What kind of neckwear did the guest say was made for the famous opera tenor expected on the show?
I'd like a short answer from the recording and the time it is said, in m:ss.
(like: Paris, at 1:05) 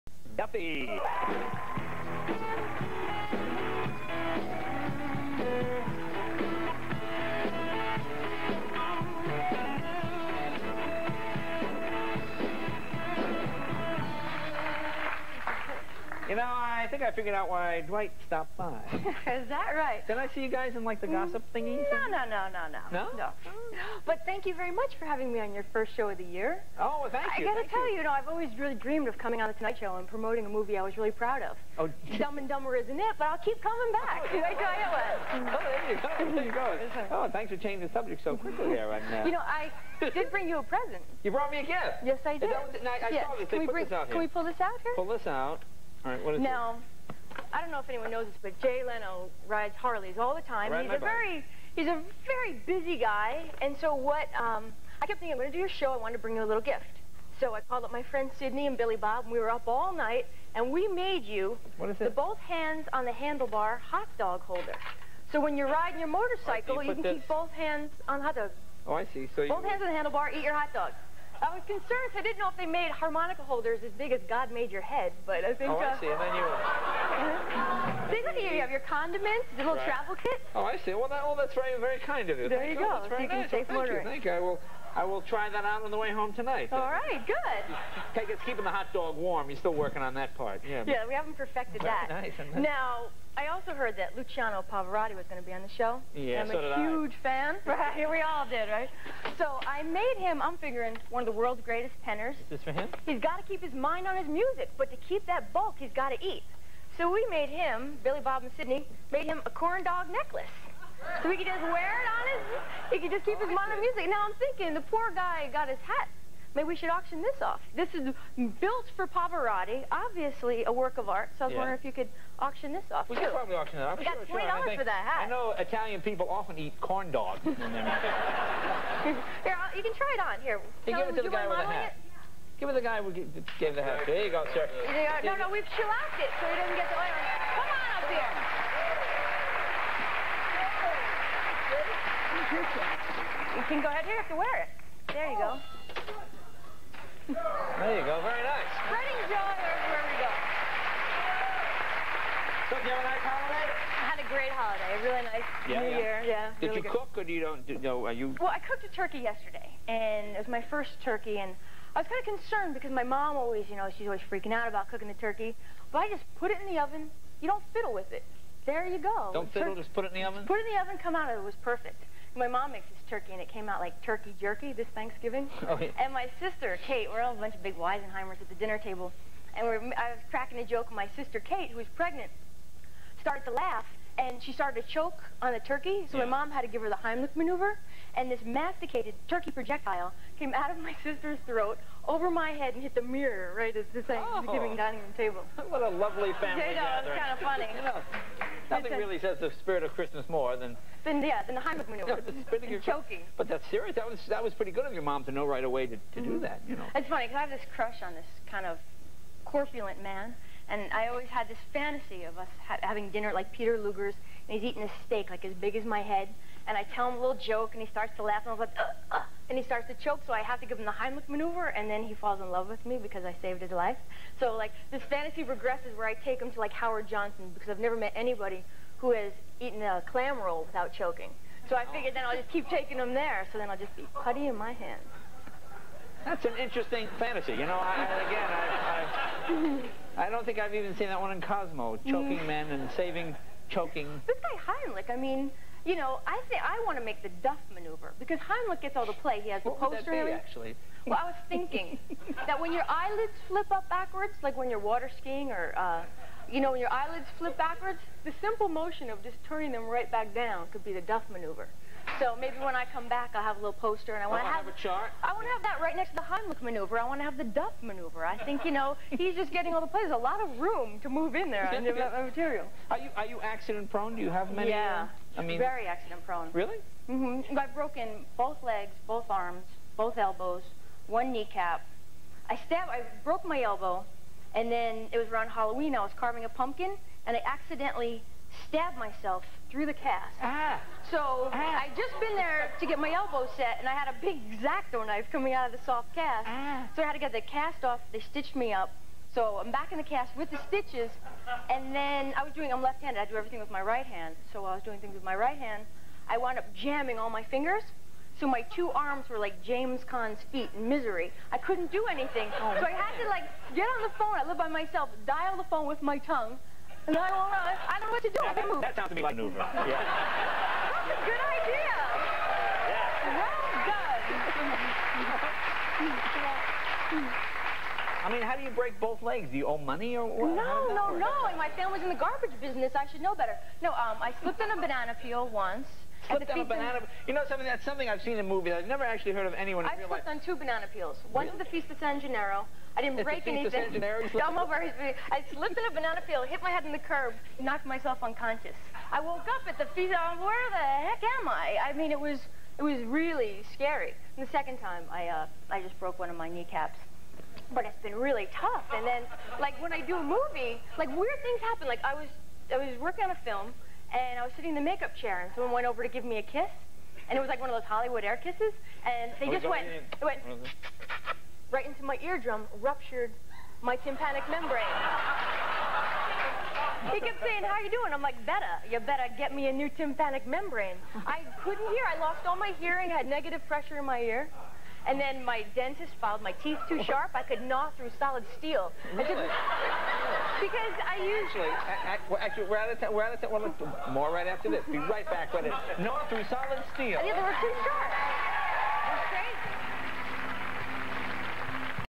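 corn dog necklace, at 1:49.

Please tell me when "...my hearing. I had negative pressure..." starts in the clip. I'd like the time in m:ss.
6:22.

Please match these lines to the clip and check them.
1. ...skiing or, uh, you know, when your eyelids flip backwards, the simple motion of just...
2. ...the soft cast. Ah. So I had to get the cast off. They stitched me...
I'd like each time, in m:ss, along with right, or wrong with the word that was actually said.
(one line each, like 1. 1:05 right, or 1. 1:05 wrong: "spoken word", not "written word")
1. 4:15 right
2. 4:55 right.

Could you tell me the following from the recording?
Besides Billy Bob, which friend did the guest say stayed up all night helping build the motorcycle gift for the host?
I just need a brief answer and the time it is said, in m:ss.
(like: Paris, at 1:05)
Sydney, at 0:58.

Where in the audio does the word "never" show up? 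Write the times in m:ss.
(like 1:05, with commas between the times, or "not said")
3:47, 5:38.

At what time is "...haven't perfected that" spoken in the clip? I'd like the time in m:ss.
1:31.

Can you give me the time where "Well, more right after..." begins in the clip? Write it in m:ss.
6:33.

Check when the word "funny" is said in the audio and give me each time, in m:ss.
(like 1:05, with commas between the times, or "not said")
3:17, 3:27.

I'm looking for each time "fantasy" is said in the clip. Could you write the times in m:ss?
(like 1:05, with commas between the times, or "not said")
3:31, 3:45, 3:57.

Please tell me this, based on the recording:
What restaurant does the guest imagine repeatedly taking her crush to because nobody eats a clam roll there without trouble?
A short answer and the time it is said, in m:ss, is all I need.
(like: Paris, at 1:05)
Howard Johnson, at 3:46.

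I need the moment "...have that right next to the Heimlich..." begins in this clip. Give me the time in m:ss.
4:25.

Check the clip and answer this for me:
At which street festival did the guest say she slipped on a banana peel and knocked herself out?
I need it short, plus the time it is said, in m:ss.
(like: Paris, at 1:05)
Feast of San Gennaro, at 5:41.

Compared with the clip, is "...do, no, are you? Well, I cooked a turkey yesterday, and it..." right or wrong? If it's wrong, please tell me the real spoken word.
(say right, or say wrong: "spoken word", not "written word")
right.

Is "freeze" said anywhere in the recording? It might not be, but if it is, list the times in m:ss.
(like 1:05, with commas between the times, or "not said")
not said.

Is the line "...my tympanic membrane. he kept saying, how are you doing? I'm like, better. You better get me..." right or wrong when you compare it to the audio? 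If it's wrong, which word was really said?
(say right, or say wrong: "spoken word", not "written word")
right.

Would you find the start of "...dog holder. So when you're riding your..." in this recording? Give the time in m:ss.
1:04.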